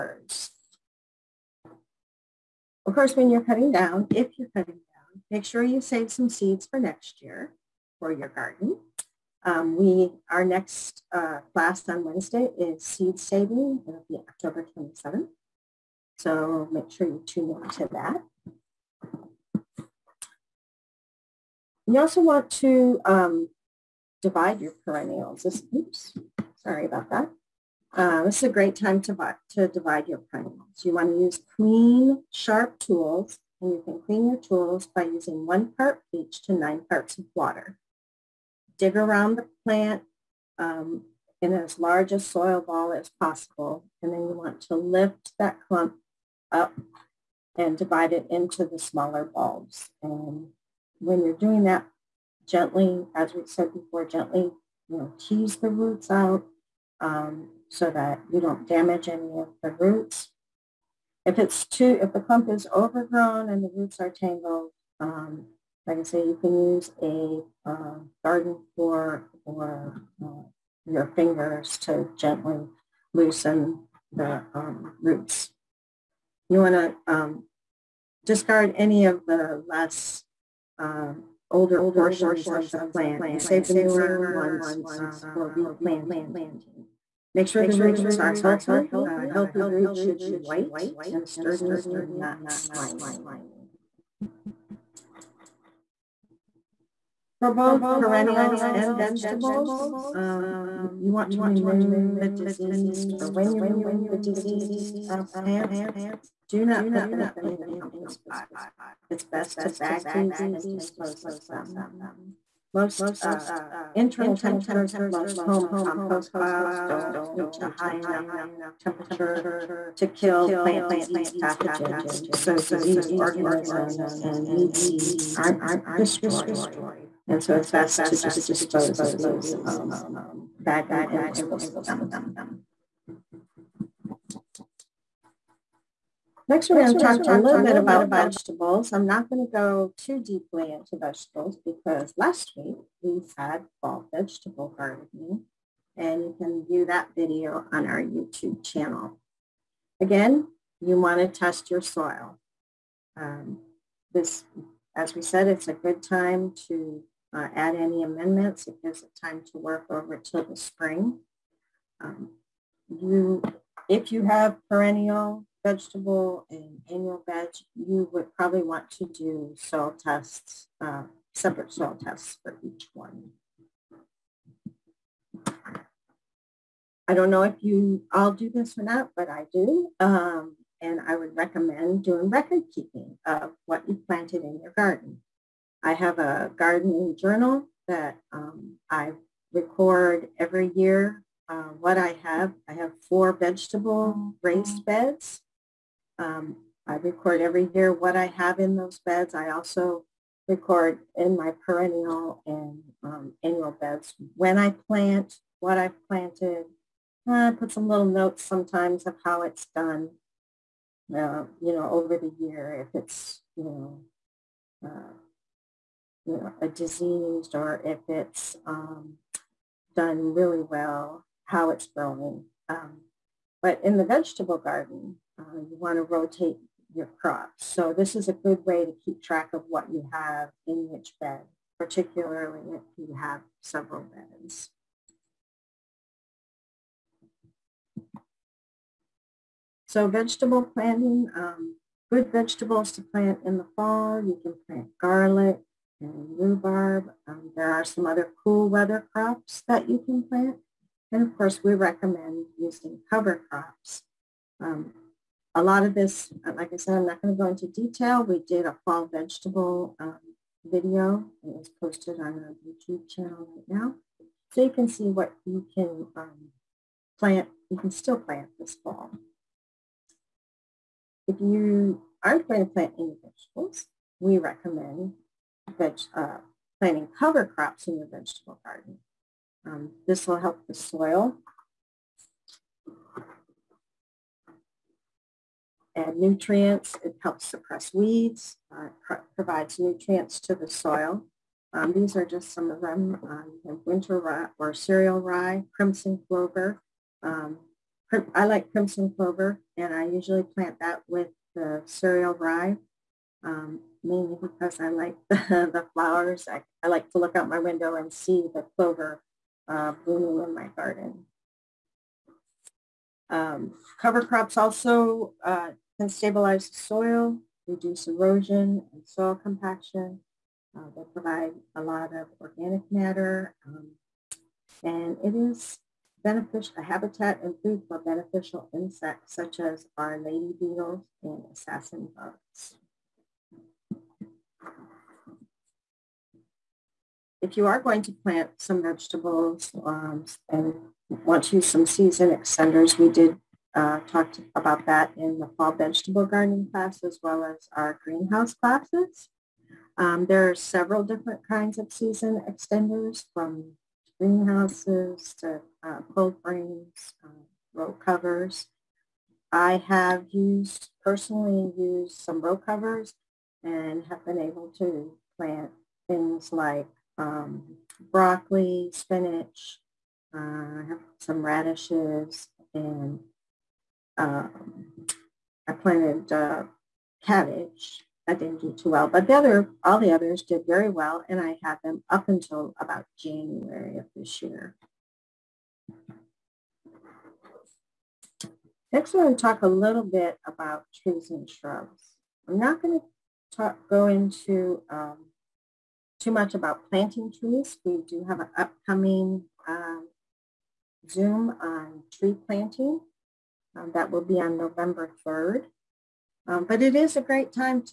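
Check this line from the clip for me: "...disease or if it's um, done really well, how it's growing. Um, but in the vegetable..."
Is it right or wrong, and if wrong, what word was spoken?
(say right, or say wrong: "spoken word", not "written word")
right.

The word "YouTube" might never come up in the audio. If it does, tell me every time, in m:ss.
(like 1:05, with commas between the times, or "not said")
2:28, 4:22.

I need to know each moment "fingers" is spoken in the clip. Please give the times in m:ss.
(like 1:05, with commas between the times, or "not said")
1:11.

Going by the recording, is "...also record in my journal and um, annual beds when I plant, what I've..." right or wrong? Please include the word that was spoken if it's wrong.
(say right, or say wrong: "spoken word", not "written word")
wrong: "perennial", not "journal".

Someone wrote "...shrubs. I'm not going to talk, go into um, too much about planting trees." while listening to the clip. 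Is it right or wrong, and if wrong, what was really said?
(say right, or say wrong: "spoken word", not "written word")
right.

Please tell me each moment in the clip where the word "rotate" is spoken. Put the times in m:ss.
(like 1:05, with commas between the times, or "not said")
3:46.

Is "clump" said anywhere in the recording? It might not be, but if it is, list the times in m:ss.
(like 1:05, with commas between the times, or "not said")
0:45, 1:02.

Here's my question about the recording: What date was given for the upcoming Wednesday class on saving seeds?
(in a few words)
October 27th.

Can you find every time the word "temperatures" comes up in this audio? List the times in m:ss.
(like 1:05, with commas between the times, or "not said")
1:54, 1:58.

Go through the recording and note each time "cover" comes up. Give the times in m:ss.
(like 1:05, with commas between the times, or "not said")
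4:13, 4:37, 5:13, 5:57, 6:02.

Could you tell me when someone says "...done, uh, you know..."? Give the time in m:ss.
3:29.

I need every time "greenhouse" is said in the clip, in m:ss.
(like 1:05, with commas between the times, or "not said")
5:48, 5:54.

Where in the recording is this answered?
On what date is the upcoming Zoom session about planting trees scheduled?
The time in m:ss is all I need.
6:44.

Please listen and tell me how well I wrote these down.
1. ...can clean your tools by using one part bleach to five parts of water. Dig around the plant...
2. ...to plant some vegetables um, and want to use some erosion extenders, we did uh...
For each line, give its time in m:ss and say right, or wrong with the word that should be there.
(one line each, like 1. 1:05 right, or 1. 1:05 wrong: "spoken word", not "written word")
1. 0:33 wrong: "nine", not "five"
2. 5:38 wrong: "season", not "erosion".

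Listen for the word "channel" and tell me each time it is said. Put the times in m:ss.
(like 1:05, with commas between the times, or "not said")
2:28, 4:23.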